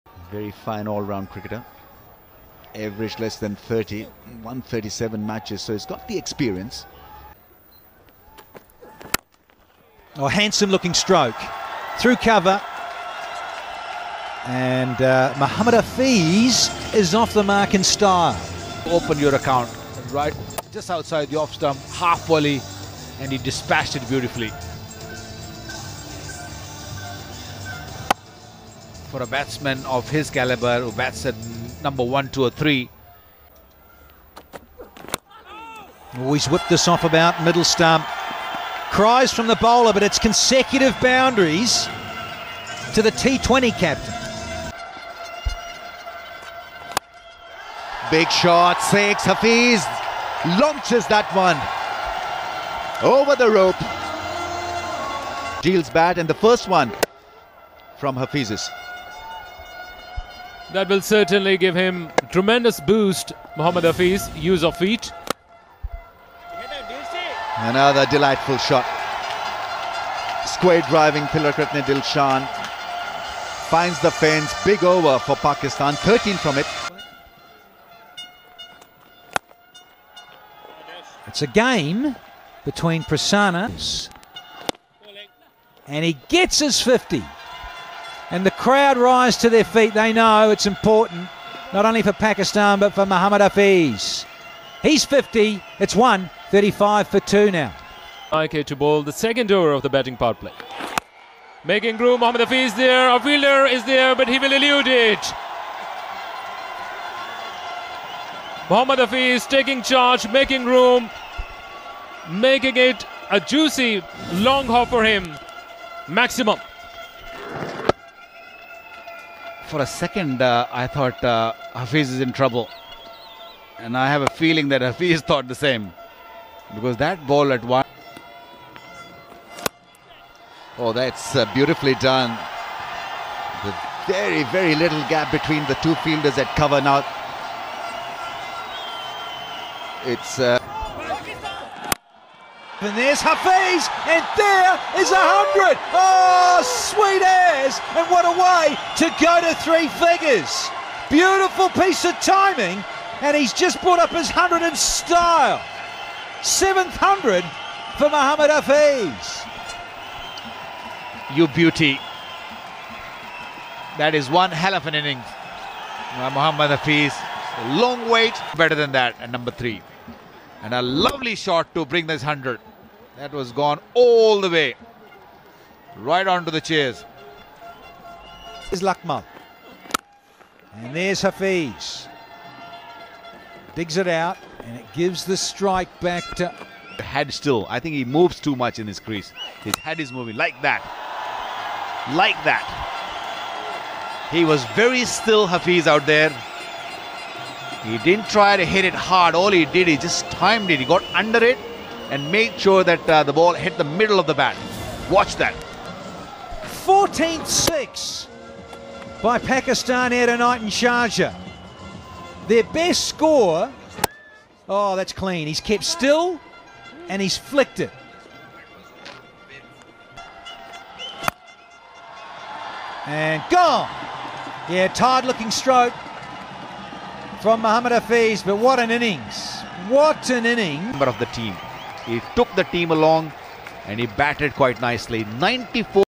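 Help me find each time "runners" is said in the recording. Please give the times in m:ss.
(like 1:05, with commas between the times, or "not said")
not said.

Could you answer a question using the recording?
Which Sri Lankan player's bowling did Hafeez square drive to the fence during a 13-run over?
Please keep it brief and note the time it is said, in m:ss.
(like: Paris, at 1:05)
Tillakaratne Dilshan, at 1:11.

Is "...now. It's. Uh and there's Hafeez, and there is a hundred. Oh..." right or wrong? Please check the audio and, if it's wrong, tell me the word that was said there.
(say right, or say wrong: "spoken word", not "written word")
right.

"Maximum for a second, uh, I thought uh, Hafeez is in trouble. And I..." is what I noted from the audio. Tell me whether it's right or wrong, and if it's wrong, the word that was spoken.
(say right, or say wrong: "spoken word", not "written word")
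right.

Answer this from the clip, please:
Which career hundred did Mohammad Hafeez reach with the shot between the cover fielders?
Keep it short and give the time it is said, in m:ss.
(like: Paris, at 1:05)
Seventh, at 2:36.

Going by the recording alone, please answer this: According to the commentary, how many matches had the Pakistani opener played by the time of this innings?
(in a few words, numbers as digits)
137.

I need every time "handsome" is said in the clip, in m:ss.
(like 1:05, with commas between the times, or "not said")
0:10.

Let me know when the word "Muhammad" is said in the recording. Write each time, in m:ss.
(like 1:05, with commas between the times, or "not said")
0:15, 1:33, 2:38, 2:46, 3:47.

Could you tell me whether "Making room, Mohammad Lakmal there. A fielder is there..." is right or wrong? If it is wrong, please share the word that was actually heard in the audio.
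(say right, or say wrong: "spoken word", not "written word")
wrong: "Hafeez", not "Lakmal".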